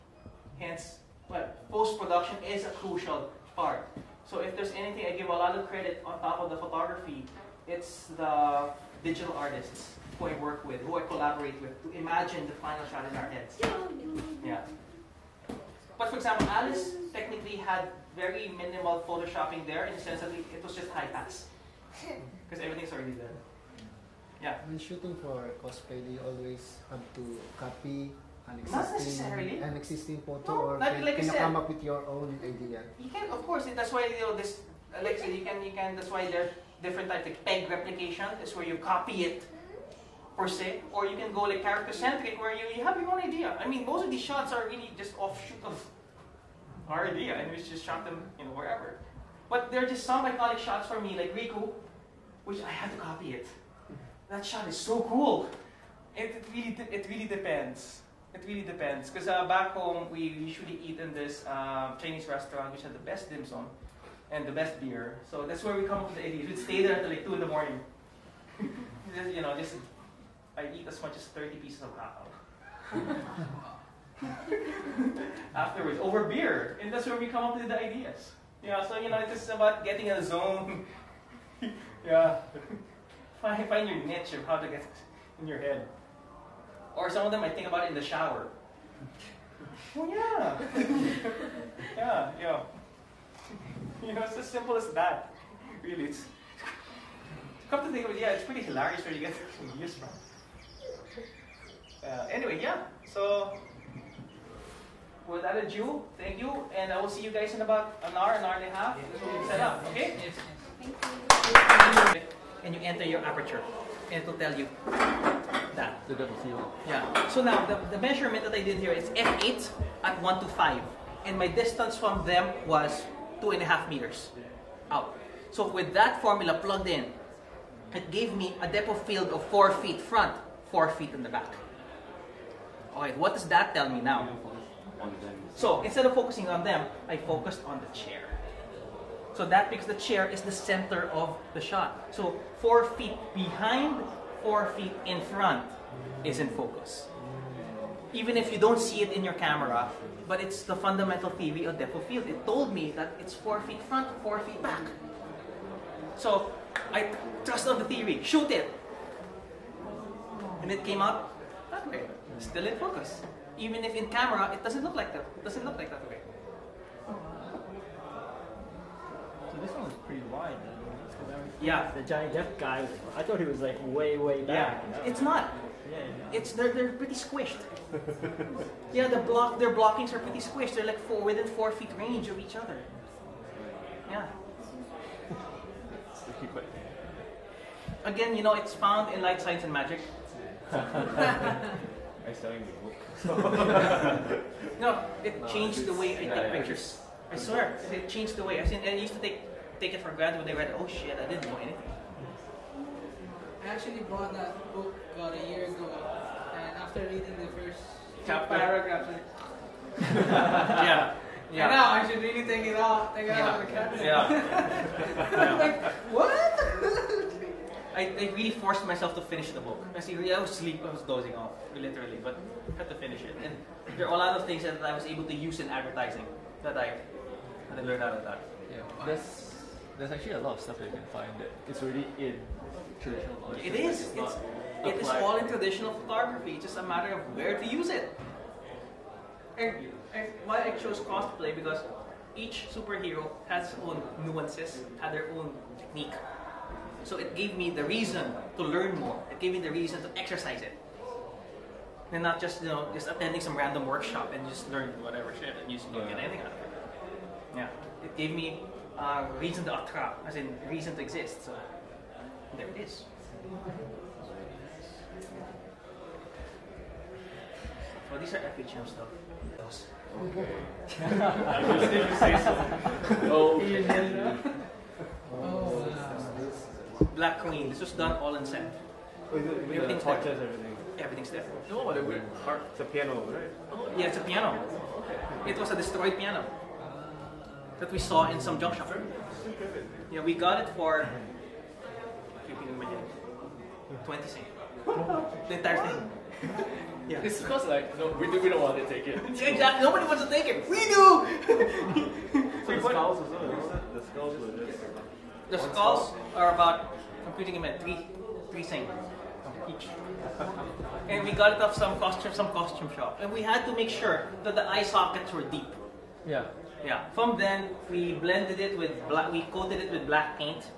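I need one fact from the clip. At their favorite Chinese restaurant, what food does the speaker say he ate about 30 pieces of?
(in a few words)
hakaw.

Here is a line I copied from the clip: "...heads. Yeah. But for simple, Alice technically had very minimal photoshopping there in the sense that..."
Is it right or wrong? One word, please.
wrong.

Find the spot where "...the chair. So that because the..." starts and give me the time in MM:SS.
02:17.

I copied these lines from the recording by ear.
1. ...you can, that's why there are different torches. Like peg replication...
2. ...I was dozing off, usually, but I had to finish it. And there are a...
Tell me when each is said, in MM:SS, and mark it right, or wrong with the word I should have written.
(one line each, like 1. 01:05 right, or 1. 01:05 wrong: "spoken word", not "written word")
1. 00:35 wrong: "types", not "torches"
2. 03:40 wrong: "literally", not "usually".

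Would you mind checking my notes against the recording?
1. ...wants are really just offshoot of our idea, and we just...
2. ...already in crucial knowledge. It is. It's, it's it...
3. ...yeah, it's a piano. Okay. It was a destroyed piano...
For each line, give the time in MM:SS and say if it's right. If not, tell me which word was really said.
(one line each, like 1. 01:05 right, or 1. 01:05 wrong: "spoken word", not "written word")
1. 00:44 wrong: "shots", not "wants"
2. 03:51 wrong: "traditional", not "crucial"
3. 04:43 right.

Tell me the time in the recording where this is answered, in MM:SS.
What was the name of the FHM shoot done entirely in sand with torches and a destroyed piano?
04:37.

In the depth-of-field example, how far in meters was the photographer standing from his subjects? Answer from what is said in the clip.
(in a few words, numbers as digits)
2.5 meters.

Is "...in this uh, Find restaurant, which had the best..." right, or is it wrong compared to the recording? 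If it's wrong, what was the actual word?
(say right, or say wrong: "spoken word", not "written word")
wrong: "Chinese", not "Find".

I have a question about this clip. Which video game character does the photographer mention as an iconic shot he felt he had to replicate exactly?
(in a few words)
Riku.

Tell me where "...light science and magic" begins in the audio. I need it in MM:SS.
03:09.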